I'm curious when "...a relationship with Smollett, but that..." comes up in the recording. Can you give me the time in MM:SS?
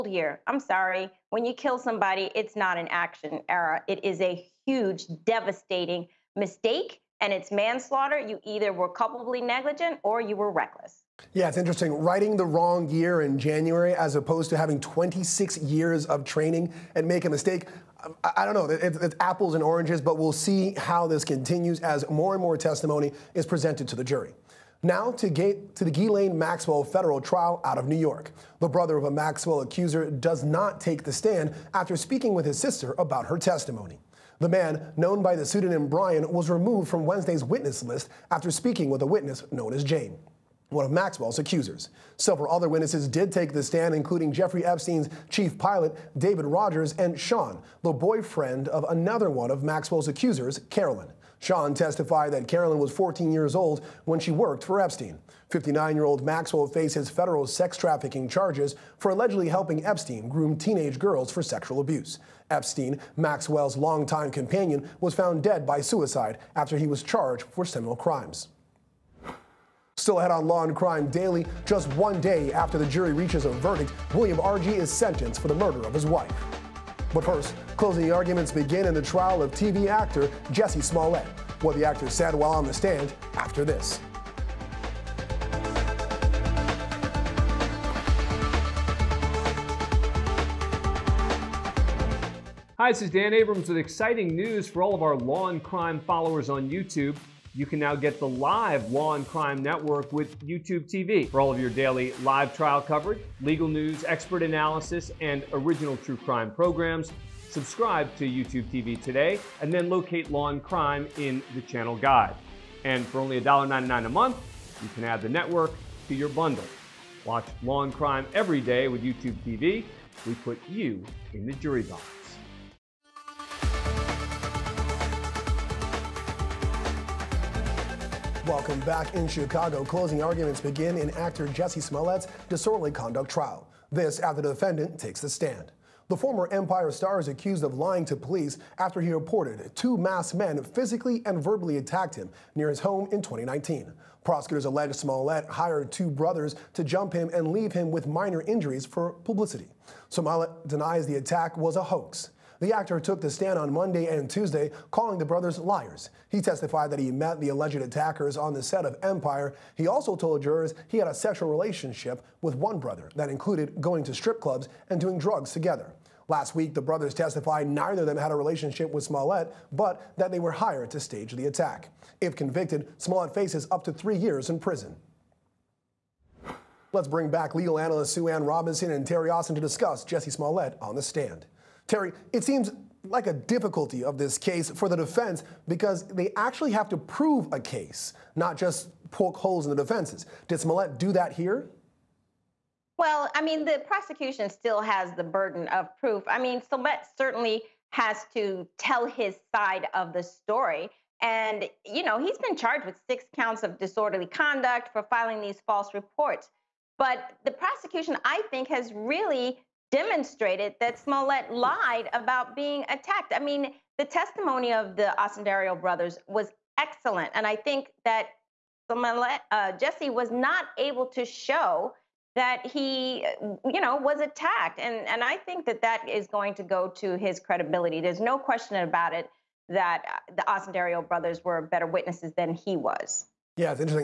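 02:48.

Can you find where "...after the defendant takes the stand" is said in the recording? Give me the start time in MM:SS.
02:14.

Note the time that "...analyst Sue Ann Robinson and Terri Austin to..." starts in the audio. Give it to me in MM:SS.
02:57.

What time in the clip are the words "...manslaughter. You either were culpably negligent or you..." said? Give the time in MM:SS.
00:07.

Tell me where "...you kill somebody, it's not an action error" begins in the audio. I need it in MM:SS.
00:01.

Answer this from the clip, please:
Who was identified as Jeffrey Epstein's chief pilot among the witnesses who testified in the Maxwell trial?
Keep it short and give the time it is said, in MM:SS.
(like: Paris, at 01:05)
David Rogers, at 00:46.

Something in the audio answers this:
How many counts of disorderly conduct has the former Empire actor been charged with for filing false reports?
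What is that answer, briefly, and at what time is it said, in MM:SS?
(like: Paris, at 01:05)
6, at 03:23.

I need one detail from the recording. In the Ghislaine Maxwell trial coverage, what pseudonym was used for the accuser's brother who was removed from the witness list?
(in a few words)
Brian.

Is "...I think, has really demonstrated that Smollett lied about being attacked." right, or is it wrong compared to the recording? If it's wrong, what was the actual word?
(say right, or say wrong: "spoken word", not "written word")
right.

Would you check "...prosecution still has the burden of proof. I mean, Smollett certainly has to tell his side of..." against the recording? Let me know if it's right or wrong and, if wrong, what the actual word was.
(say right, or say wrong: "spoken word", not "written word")
right.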